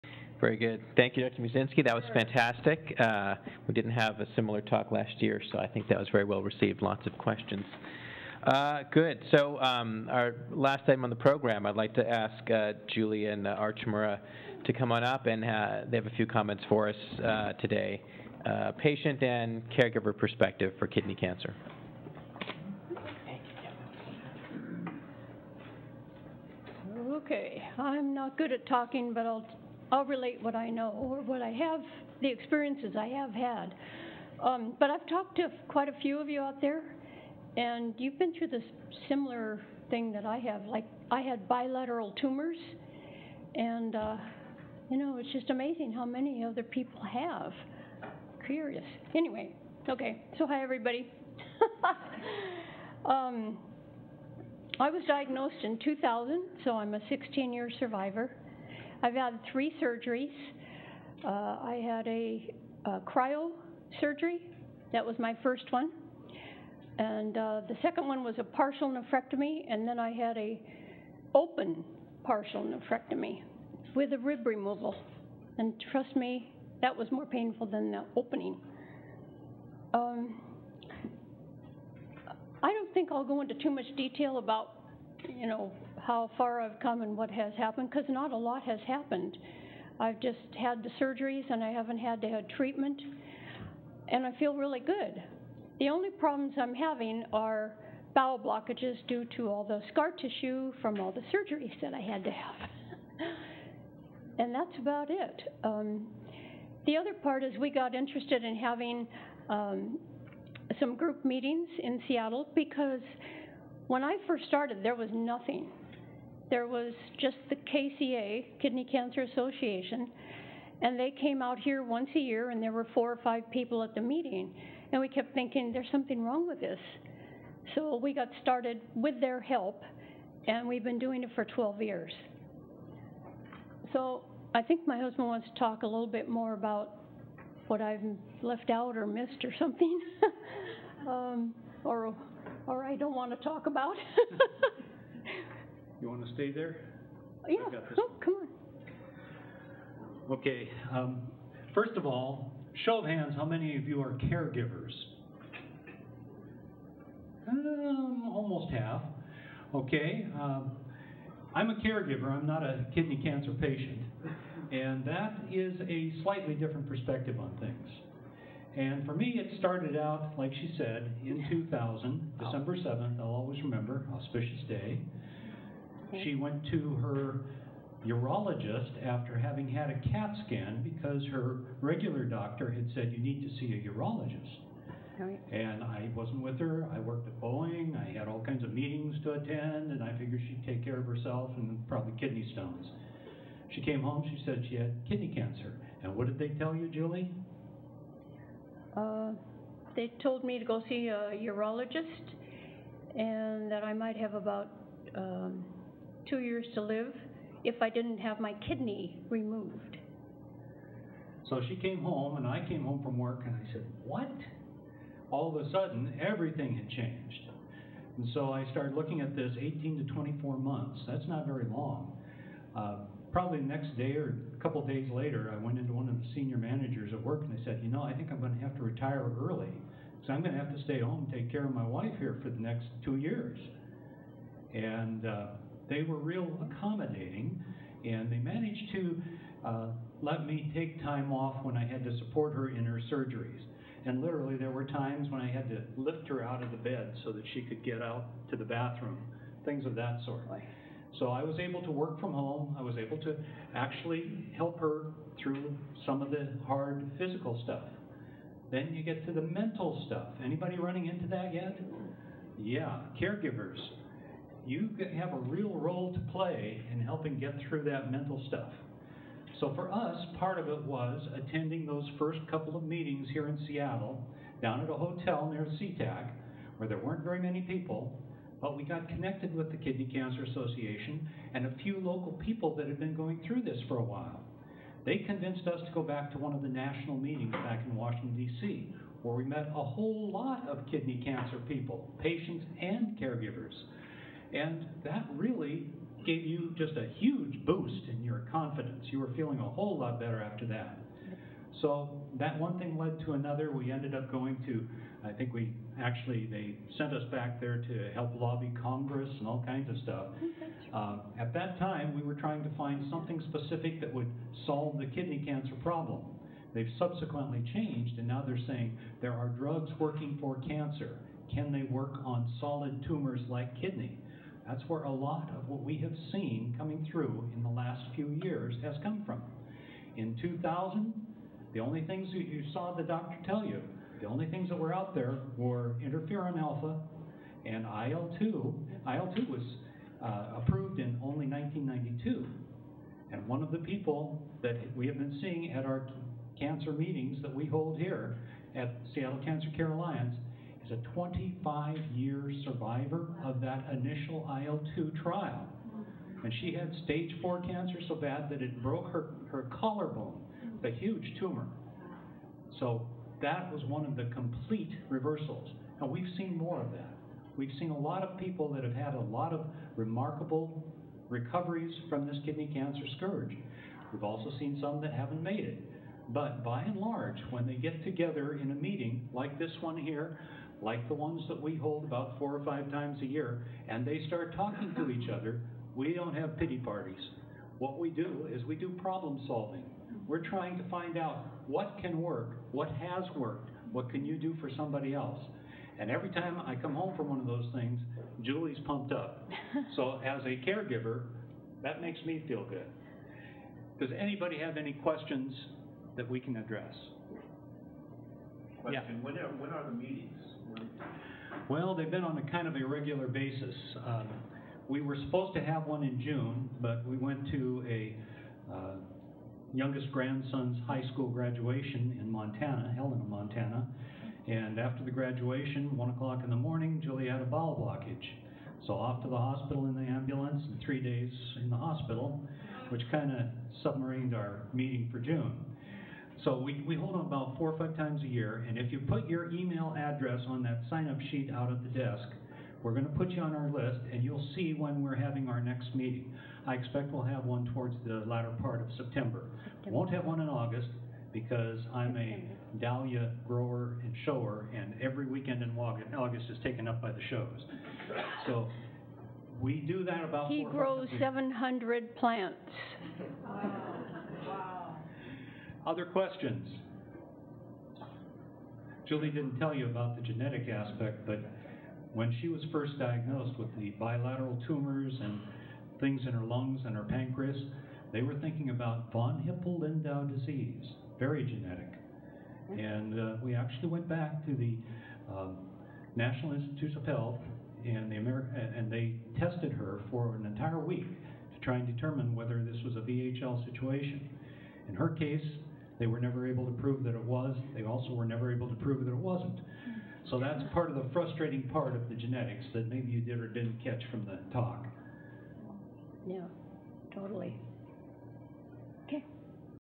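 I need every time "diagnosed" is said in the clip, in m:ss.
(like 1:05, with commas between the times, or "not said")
0:55, 7:52.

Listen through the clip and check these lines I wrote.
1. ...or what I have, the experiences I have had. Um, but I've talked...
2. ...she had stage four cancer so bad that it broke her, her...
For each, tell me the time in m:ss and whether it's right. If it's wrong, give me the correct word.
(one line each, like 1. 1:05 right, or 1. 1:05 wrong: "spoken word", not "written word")
1. 0:30 right
2. 5:56 right.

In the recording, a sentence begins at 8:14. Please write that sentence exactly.
In her case, they were never able to prove that it was.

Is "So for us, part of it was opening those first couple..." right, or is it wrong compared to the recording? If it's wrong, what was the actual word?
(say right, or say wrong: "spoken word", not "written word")
wrong: "attending", not "opening".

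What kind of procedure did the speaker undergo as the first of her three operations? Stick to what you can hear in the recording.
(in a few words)
Cryo surgery.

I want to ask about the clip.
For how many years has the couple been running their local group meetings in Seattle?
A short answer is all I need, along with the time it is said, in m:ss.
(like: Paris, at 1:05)
12, at 2:11.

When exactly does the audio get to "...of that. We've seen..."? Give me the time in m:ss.
6:06.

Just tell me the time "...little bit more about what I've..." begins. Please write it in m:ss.
2:15.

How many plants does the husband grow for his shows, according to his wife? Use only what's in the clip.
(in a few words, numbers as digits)
700.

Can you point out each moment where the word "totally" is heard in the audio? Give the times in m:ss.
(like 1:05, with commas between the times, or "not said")
8:27.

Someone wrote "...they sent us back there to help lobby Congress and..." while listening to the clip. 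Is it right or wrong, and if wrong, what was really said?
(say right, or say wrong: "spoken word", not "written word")
right.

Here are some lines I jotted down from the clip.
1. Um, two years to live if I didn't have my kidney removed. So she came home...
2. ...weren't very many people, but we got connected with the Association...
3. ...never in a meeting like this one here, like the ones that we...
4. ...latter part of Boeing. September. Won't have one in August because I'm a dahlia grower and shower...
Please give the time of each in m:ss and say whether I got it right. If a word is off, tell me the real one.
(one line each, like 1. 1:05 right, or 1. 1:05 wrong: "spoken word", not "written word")
1. 3:25 right
2. 4:36 wrong: "Kidney", not "Association"
3. 6:18 wrong: "together", not "never"
4. 7:28 wrong: "September", not "Boeing".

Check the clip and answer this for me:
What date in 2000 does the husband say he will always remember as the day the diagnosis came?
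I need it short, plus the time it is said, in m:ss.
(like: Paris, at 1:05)
December 7th, at 2:52.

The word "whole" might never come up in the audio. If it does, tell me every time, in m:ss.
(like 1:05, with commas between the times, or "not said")
4:49, 4:59.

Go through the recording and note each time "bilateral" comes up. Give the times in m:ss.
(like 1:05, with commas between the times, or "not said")
0:41, 7:53.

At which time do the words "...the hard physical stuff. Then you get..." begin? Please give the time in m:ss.
4:16.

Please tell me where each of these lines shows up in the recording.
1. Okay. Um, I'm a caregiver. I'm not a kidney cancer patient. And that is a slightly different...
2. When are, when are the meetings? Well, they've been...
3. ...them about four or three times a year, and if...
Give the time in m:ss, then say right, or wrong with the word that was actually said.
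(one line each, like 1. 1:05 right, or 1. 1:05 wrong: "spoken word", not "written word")
1. 2:39 right
2. 6:49 right
3. 7:17 wrong: "five", not "three".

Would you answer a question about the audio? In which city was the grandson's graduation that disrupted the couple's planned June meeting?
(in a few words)
Helena, Montana.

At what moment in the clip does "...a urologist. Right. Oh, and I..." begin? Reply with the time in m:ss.
3:03.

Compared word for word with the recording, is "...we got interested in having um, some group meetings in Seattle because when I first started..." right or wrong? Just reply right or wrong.
right.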